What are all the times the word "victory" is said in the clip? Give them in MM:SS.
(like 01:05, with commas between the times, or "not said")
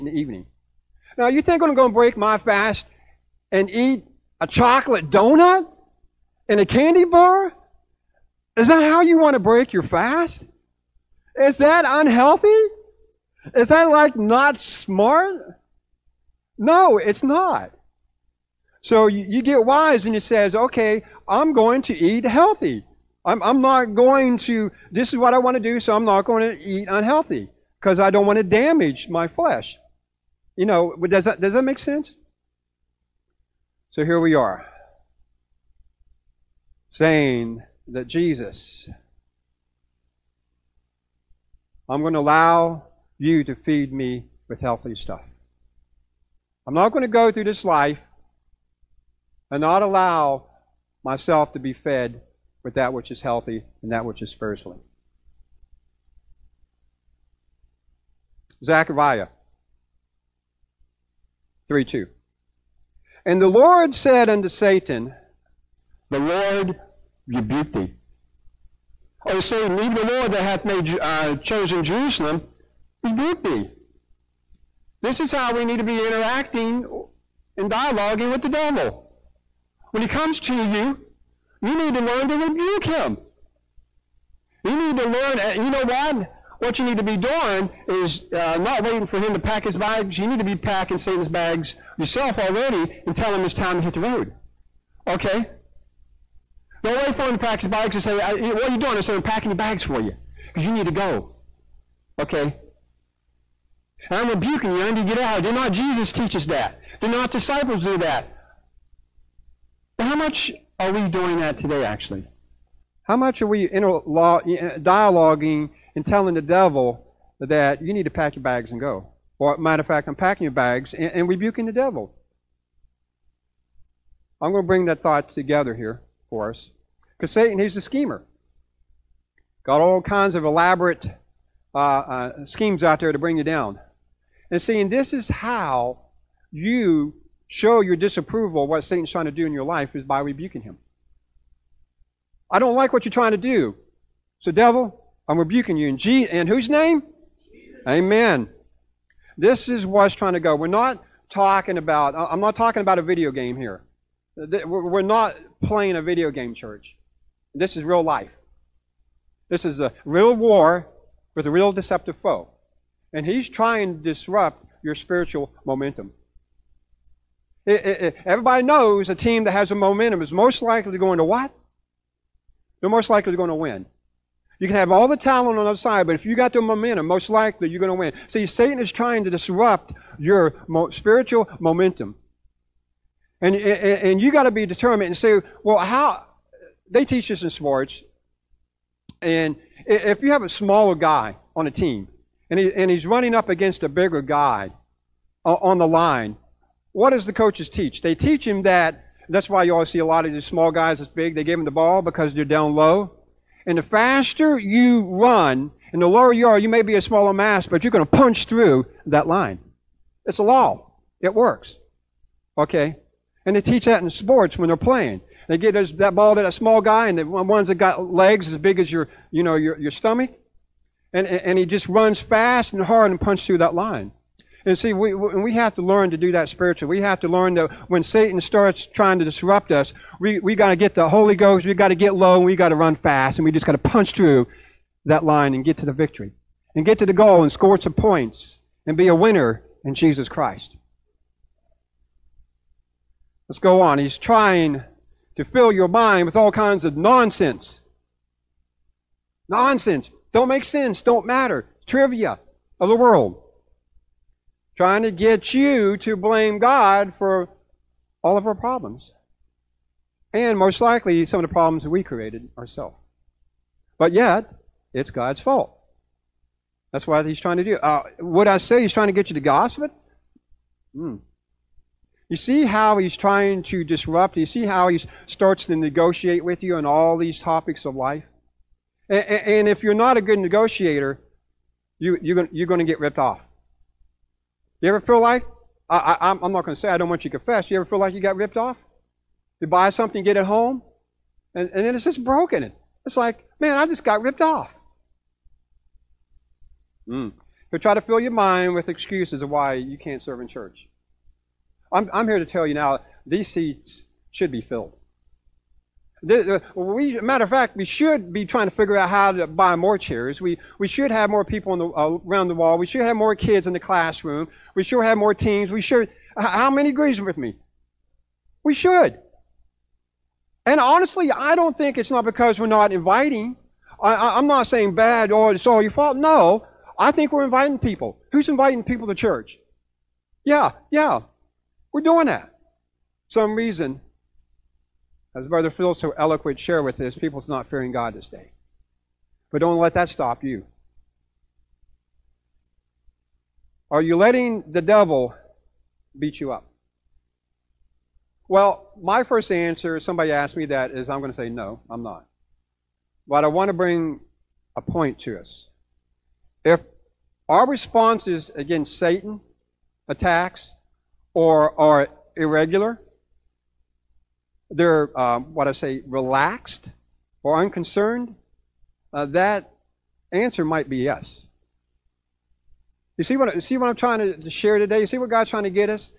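03:55.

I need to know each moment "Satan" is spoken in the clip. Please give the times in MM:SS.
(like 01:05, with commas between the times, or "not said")
01:04, 01:09, 01:30, 02:07, 02:18, 02:58, 03:48, 05:58.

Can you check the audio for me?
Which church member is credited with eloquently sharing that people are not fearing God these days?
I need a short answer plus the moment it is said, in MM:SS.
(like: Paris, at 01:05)
Brother Phil, at 05:35.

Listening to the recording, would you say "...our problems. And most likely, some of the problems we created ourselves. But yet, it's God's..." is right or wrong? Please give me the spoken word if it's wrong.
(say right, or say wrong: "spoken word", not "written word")
right.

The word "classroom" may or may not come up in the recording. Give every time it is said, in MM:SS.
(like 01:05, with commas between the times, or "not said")
05:13.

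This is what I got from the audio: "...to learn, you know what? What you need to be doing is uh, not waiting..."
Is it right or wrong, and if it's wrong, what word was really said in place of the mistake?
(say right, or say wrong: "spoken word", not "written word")
right.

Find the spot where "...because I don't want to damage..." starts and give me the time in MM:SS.
00:27.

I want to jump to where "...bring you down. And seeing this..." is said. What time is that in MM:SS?
02:13.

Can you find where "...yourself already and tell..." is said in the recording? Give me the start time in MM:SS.
01:31.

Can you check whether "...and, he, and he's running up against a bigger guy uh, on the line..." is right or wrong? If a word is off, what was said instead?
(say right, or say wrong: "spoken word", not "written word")
right.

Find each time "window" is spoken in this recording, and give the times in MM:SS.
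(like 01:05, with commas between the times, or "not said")
not said.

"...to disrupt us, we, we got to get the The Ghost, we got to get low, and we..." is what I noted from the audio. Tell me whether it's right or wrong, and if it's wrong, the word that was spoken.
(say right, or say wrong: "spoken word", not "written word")
wrong: "Holy", not "The".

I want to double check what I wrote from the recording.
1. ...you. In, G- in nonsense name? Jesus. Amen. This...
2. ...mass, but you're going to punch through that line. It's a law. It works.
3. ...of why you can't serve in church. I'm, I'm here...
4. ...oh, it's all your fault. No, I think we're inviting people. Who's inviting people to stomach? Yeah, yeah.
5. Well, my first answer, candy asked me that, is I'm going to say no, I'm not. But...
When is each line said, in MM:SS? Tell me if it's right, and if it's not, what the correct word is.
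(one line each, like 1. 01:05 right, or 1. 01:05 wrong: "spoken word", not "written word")
1. 02:25 wrong: "whose", not "nonsense"
2. 03:27 right
3. 04:59 right
4. 05:25 wrong: "church", not "stomach"
5. 05:48 wrong: "somebody", not "candy".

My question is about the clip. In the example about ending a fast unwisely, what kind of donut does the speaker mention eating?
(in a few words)
chocolate.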